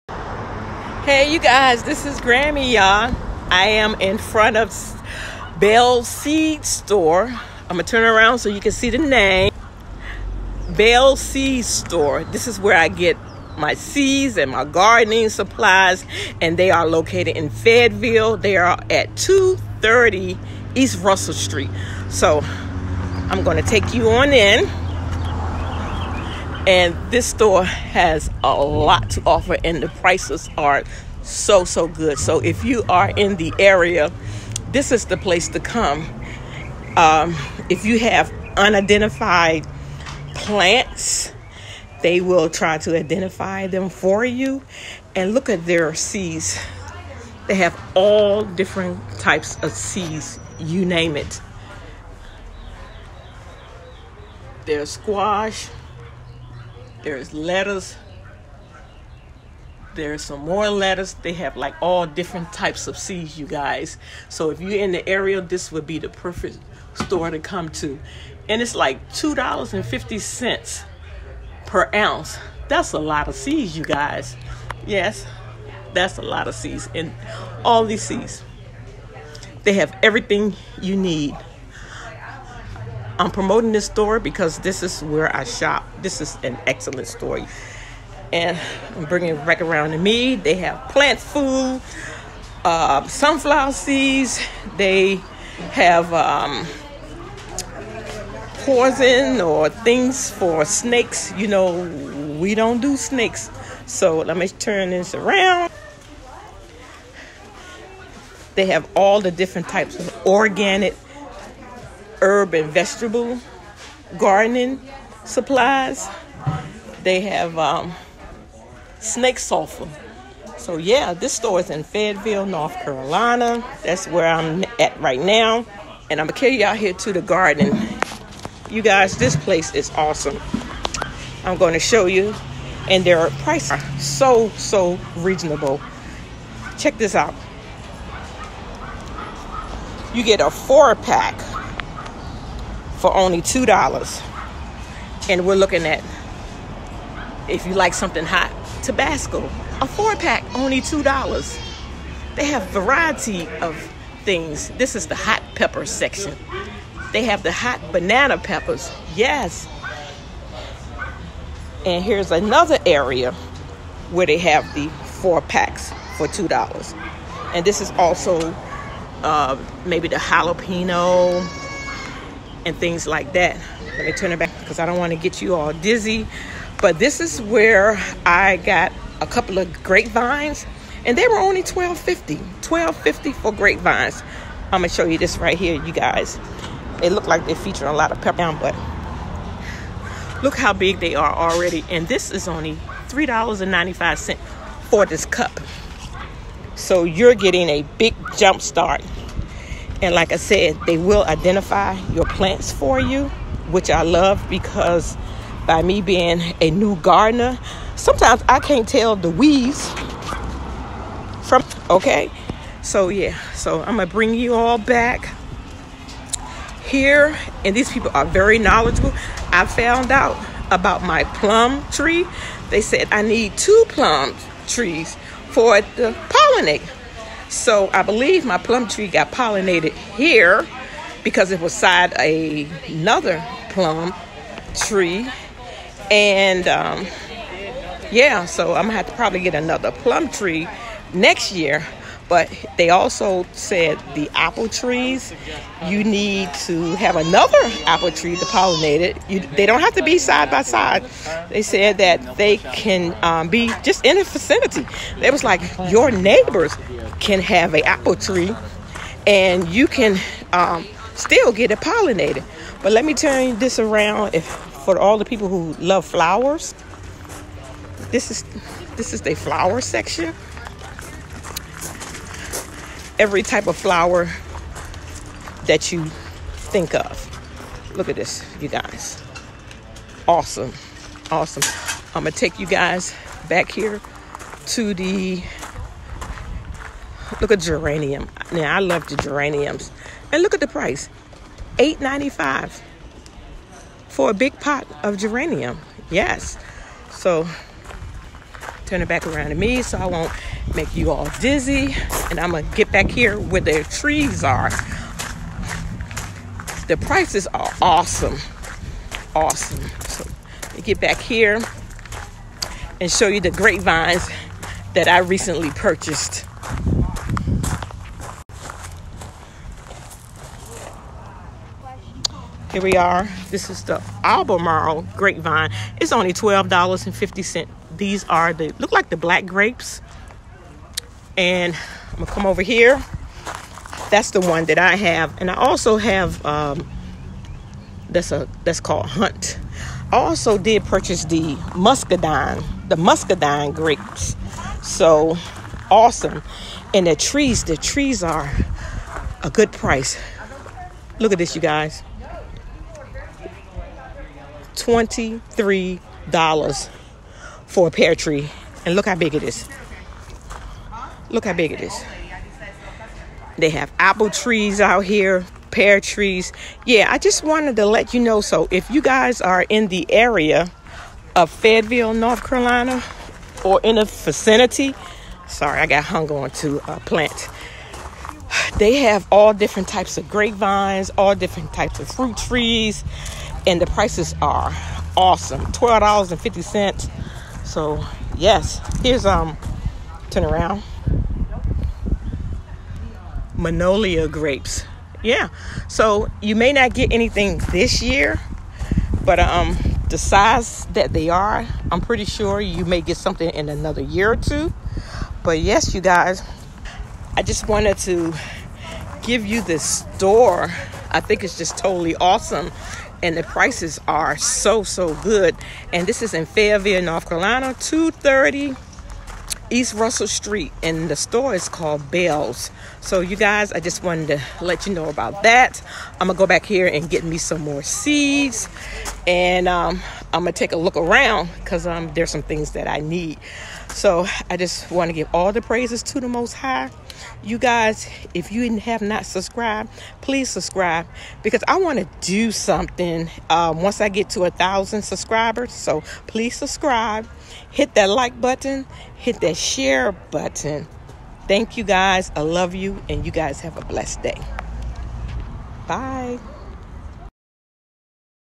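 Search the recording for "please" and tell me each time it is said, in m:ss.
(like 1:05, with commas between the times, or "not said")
7:20, 7:26.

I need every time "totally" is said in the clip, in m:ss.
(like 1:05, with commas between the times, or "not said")
6:51.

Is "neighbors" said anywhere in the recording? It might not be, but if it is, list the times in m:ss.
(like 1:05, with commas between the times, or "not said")
4:16.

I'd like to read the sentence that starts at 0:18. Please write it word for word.
They are at 230 East Russell Street.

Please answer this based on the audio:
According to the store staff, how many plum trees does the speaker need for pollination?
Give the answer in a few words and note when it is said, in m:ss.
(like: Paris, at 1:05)
2, at 3:43.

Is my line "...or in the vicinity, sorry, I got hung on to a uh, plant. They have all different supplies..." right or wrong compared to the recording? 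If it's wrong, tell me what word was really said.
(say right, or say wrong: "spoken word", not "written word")
wrong: "types", not "supplies".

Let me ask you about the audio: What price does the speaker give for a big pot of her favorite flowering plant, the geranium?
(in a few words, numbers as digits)
$8.95.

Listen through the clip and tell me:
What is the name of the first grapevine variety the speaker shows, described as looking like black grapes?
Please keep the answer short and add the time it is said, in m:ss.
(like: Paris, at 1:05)
Albemarle, at 5:24.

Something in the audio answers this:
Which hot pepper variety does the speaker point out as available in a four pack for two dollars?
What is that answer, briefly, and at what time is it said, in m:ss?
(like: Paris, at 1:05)
Tabasco, at 2:28.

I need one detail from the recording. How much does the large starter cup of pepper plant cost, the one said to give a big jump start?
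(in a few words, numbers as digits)
$3.95.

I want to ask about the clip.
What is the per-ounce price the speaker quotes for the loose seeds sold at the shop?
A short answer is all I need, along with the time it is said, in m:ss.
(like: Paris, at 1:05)
$2.50, at 1:09.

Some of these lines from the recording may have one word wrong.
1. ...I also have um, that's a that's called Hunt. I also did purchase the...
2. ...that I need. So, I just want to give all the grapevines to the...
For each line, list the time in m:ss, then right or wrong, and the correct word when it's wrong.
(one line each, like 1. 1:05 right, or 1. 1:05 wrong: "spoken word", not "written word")
1. 5:35 right
2. 7:12 wrong: "praises", not "grapevines".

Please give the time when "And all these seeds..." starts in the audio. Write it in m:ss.
1:16.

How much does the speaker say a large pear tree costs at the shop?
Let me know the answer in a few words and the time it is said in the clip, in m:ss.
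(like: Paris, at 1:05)
$23, at 5:54.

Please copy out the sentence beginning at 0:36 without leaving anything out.
Um, if you have unidentified plants, they will try to identify them for you.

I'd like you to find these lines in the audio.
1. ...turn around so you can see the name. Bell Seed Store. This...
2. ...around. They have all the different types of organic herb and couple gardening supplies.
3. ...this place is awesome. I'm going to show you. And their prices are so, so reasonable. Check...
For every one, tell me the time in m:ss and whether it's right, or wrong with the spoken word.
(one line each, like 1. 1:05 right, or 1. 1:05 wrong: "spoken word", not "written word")
1. 0:07 right
2. 1:45 wrong: "vegetable", not "couple"
3. 2:09 right.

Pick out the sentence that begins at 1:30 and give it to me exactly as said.
They have plant food, uh, sunflower seeds.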